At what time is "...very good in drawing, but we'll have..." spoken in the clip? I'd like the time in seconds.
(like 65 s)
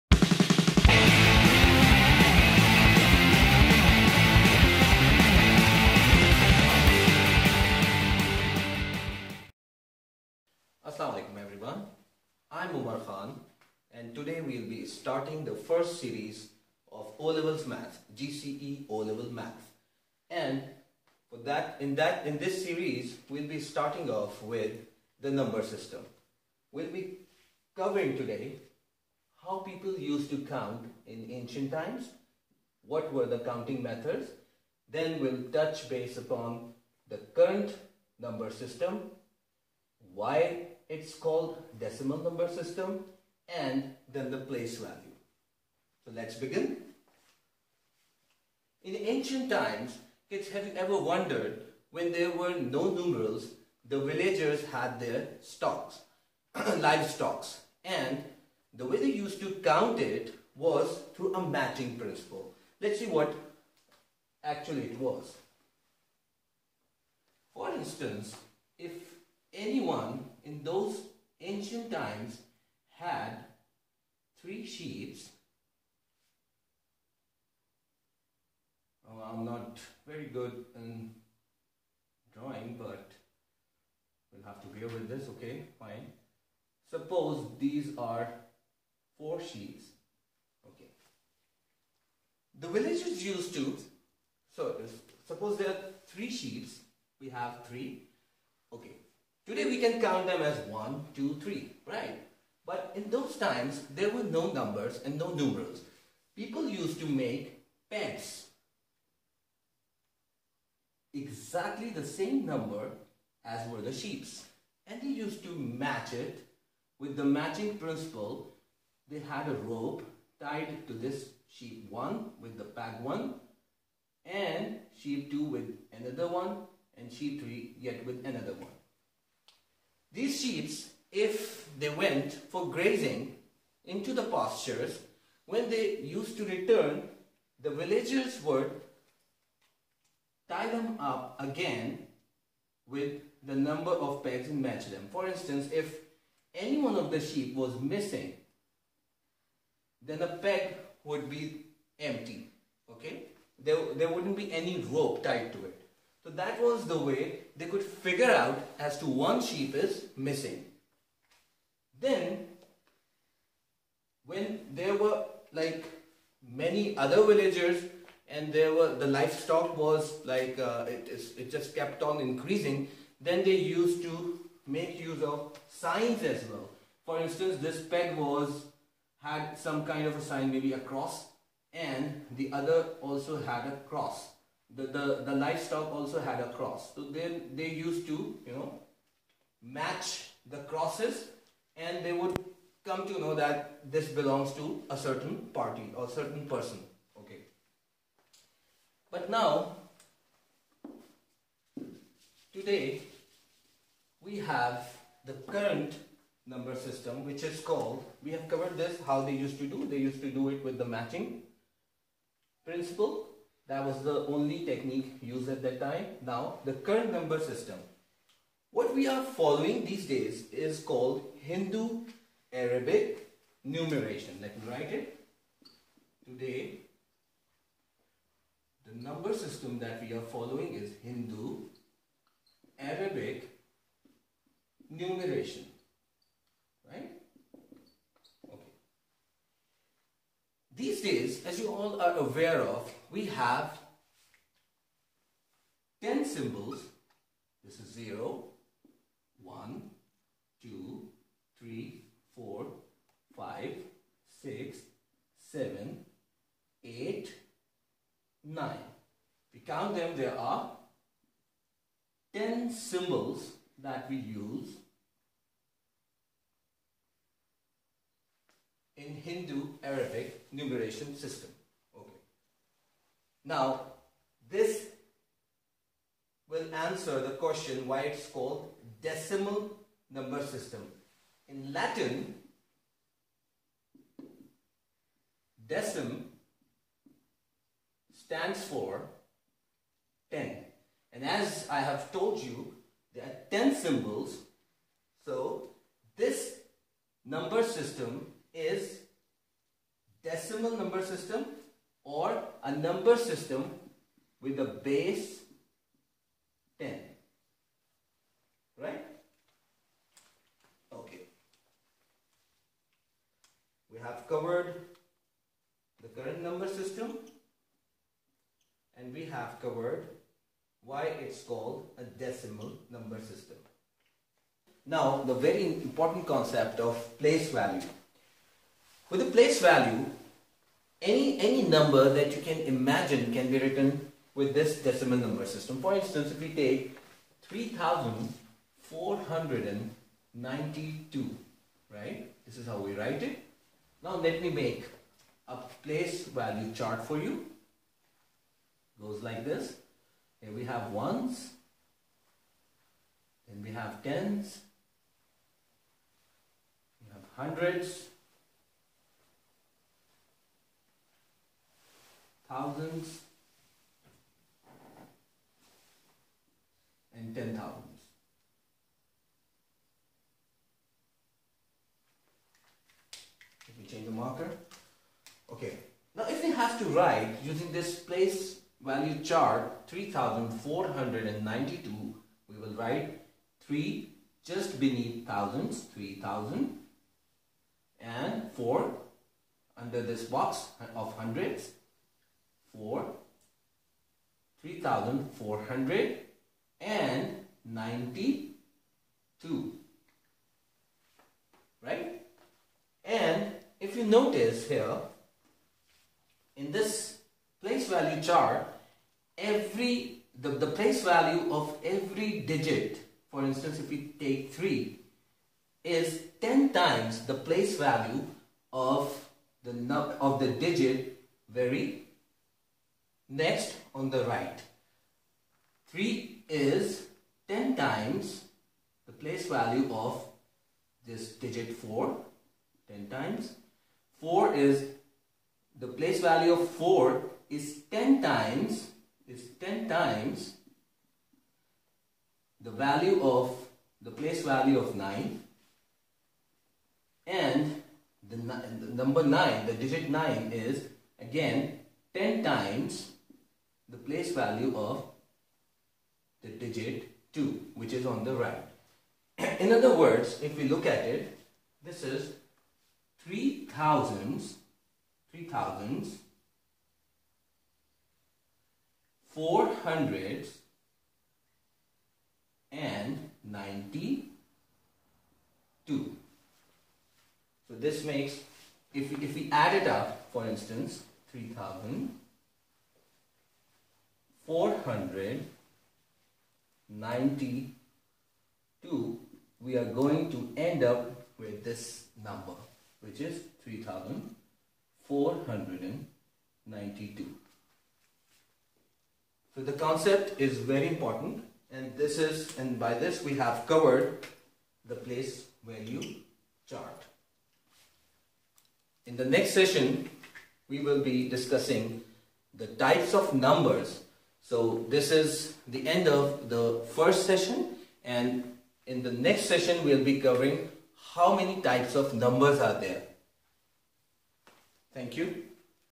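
80 s.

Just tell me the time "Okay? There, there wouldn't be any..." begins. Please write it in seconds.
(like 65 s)
152 s.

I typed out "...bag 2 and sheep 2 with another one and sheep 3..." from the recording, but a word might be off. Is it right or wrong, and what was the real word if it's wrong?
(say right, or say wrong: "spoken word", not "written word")
wrong: "1", not "2".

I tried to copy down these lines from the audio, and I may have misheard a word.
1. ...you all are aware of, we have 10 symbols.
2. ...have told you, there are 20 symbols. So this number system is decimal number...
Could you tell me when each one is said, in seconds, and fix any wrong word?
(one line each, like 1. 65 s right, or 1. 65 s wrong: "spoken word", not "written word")
1. 241 s right
2. 291 s wrong: "10", not "20".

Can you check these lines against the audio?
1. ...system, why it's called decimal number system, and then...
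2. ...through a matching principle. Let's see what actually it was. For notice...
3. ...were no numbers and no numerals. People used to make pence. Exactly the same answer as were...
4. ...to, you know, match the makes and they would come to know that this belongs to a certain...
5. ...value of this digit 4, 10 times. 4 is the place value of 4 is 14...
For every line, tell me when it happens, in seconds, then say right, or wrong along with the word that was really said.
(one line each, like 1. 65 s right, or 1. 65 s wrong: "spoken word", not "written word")
1. 38 s right
2. 61 s wrong: "instance", not "notice"
3. 104 s wrong: "number", not "answer"
4. 188 s wrong: "crosses", not "makes"
5. 429 s wrong: "10", not "14".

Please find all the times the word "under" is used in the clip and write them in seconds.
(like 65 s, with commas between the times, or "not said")
389 s.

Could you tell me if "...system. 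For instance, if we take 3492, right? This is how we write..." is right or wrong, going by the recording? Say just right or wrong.
right.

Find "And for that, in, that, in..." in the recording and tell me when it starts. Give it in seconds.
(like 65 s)
20 s.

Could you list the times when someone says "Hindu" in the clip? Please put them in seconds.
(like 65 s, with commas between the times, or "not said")
221 s, 231 s, 269 s.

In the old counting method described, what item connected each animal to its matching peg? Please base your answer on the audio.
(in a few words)
A rope.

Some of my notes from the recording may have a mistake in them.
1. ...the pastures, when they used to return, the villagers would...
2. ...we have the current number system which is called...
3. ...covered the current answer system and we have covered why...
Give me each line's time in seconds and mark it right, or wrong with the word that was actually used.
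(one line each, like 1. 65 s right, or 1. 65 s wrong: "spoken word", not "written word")
1. 134 s right
2. 204 s right
3. 314 s wrong: "number", not "answer".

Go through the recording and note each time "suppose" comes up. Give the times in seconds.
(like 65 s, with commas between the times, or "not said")
86 s, 95 s.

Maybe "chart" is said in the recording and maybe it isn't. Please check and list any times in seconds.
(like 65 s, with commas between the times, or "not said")
346 s, 379 s, 408 s, 506 s.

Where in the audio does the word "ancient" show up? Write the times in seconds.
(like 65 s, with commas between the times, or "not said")
31 s, 48 s, 71 s.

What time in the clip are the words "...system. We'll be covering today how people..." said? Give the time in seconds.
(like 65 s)
25 s.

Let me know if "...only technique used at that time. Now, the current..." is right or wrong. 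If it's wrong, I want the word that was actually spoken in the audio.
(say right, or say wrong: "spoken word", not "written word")
right.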